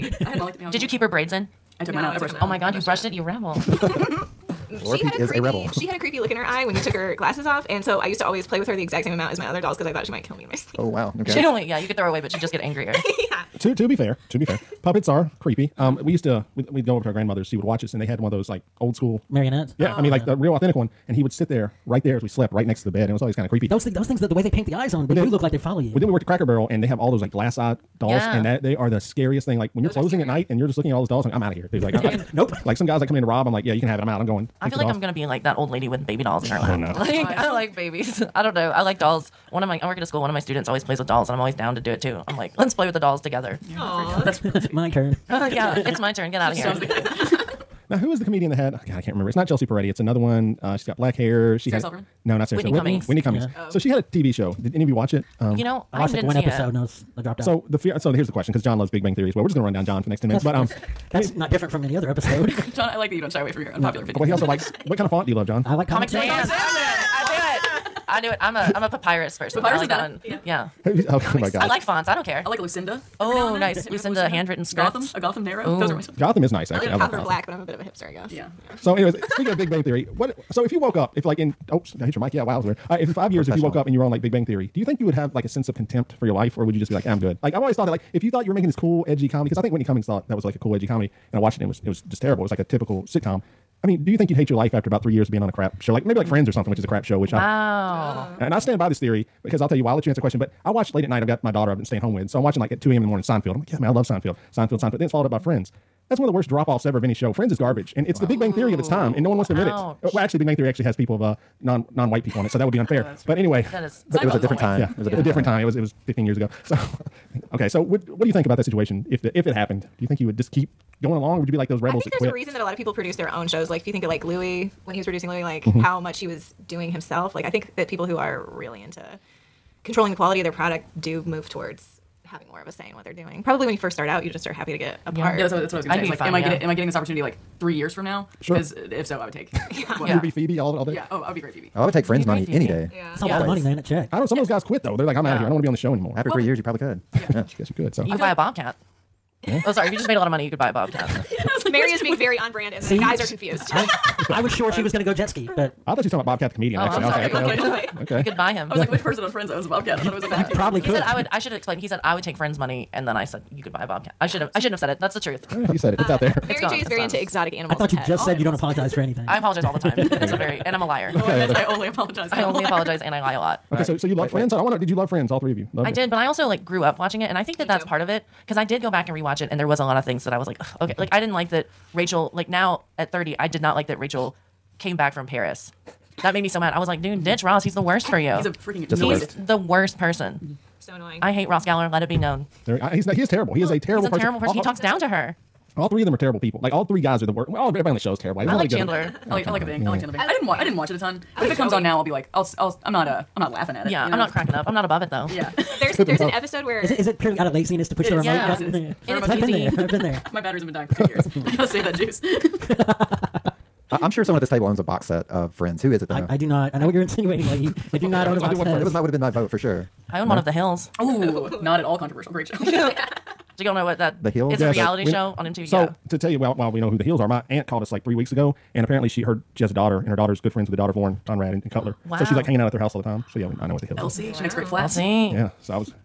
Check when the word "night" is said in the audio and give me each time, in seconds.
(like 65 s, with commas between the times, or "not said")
30 s, 101 s.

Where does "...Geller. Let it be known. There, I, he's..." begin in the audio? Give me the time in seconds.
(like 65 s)
191 s.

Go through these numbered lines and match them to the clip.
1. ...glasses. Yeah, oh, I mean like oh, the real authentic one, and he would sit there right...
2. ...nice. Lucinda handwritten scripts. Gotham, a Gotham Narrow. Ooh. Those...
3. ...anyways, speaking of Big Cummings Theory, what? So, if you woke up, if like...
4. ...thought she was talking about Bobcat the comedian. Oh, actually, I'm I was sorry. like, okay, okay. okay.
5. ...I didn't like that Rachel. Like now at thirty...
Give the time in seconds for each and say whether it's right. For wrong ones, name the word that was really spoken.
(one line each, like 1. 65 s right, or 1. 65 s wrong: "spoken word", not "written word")
1. 19 s wrong: "marionettes", not "glasses"
2. 73 s right
3. 78 s wrong: "Bang", not "Cummings"
4. 155 s right
5. 181 s right.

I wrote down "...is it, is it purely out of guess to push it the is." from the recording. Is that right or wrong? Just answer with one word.
wrong.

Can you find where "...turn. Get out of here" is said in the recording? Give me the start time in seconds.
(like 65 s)
46 s.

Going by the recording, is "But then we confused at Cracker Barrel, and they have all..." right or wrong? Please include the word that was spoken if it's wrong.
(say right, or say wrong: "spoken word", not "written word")
wrong: "worked", not "confused".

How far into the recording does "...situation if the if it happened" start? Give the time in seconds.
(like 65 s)
118 s.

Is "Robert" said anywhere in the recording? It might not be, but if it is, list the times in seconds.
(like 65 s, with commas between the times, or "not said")
not said.